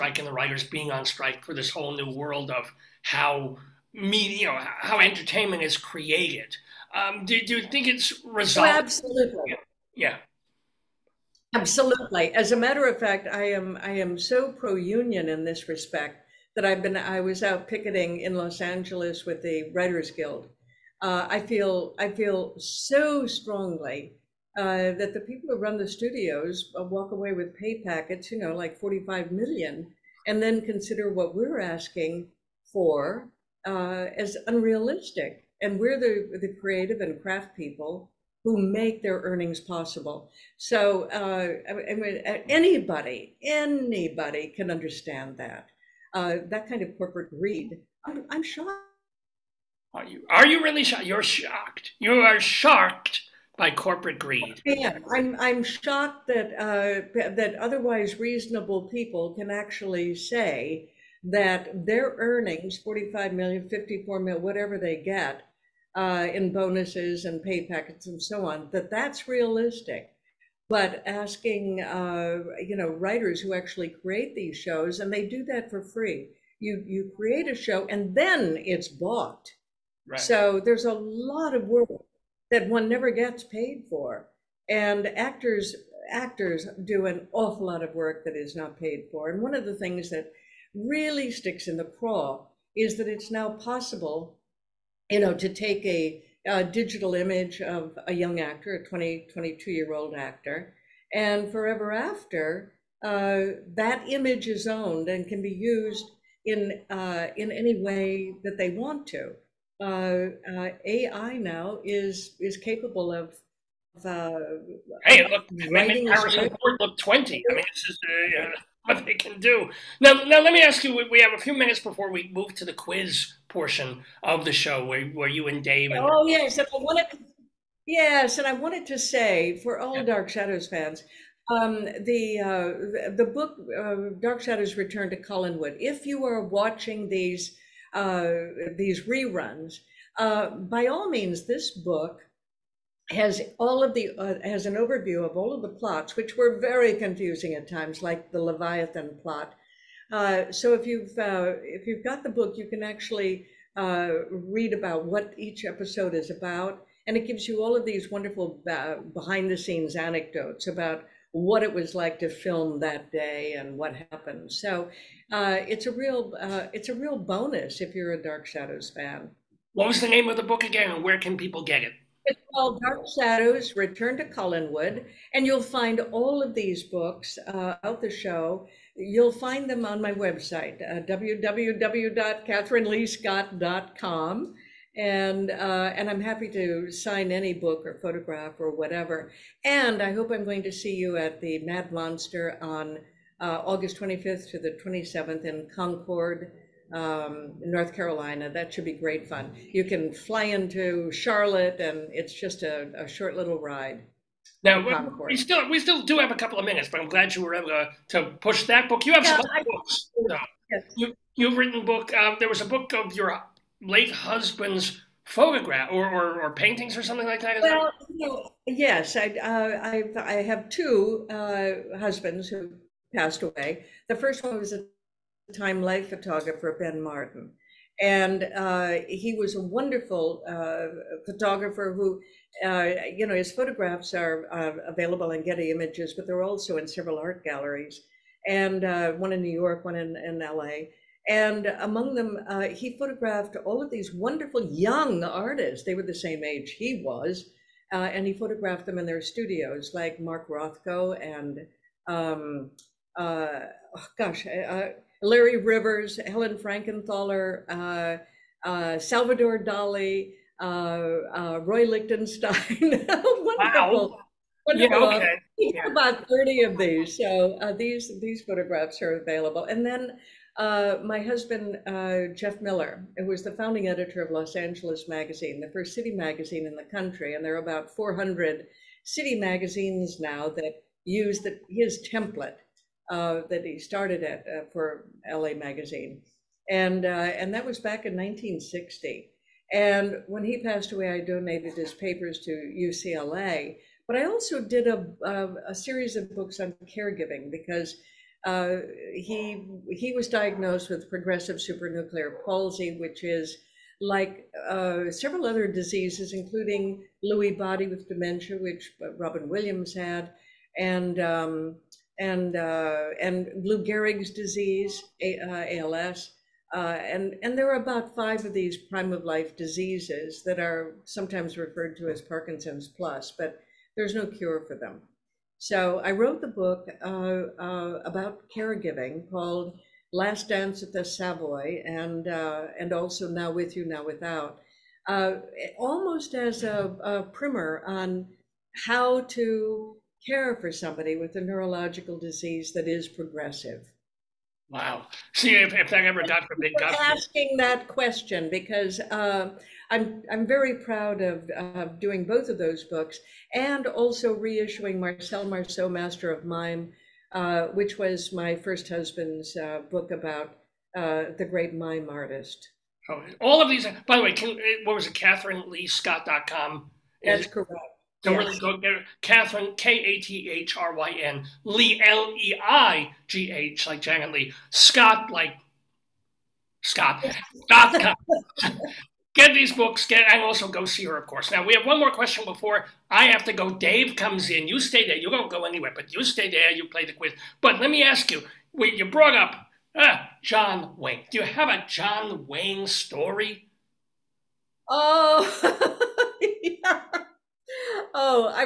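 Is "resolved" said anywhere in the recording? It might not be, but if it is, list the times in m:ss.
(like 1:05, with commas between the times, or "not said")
0:08.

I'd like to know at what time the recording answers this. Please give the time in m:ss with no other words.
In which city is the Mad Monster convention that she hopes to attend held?
3:15.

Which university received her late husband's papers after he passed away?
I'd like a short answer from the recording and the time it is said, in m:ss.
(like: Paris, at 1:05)
UCLA, at 4:52.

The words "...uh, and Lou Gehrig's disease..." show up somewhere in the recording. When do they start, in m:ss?
5:12.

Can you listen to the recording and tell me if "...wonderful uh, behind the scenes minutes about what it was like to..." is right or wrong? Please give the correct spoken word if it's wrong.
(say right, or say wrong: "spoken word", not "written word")
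wrong: "anecdotes", not "minutes".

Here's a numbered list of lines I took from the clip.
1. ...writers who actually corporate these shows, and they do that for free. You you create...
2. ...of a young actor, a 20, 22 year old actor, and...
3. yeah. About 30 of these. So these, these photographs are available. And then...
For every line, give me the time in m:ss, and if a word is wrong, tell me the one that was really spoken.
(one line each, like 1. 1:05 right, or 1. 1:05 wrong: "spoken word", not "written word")
1. 1:12 wrong: "create", not "corporate"
2. 1:37 right
3. 4:25 right.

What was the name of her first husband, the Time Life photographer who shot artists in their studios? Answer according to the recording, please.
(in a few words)
Ben Martin.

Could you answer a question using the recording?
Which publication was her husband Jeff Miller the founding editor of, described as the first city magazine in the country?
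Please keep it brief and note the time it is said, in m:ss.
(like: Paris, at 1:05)
Los Angeles Magazine, at 4:34.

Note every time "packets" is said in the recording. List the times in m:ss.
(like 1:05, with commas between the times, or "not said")
0:27, 1:07.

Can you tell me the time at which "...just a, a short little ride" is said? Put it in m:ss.
3:22.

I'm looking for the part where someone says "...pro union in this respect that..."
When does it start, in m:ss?
0:14.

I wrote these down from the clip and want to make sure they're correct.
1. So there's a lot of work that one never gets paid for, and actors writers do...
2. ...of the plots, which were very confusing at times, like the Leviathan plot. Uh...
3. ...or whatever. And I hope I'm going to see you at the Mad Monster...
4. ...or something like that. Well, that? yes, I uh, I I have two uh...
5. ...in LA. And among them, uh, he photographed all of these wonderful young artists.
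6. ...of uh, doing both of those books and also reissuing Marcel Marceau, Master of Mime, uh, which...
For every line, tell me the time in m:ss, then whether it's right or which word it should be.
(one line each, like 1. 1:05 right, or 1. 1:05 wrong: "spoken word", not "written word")
1. 1:20 wrong: "actors", not "writers"
2. 2:25 right
3. 3:08 right
4. 3:36 right
5. 4:00 right
6. 5:51 right.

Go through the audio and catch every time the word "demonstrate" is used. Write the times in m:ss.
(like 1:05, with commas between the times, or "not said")
not said.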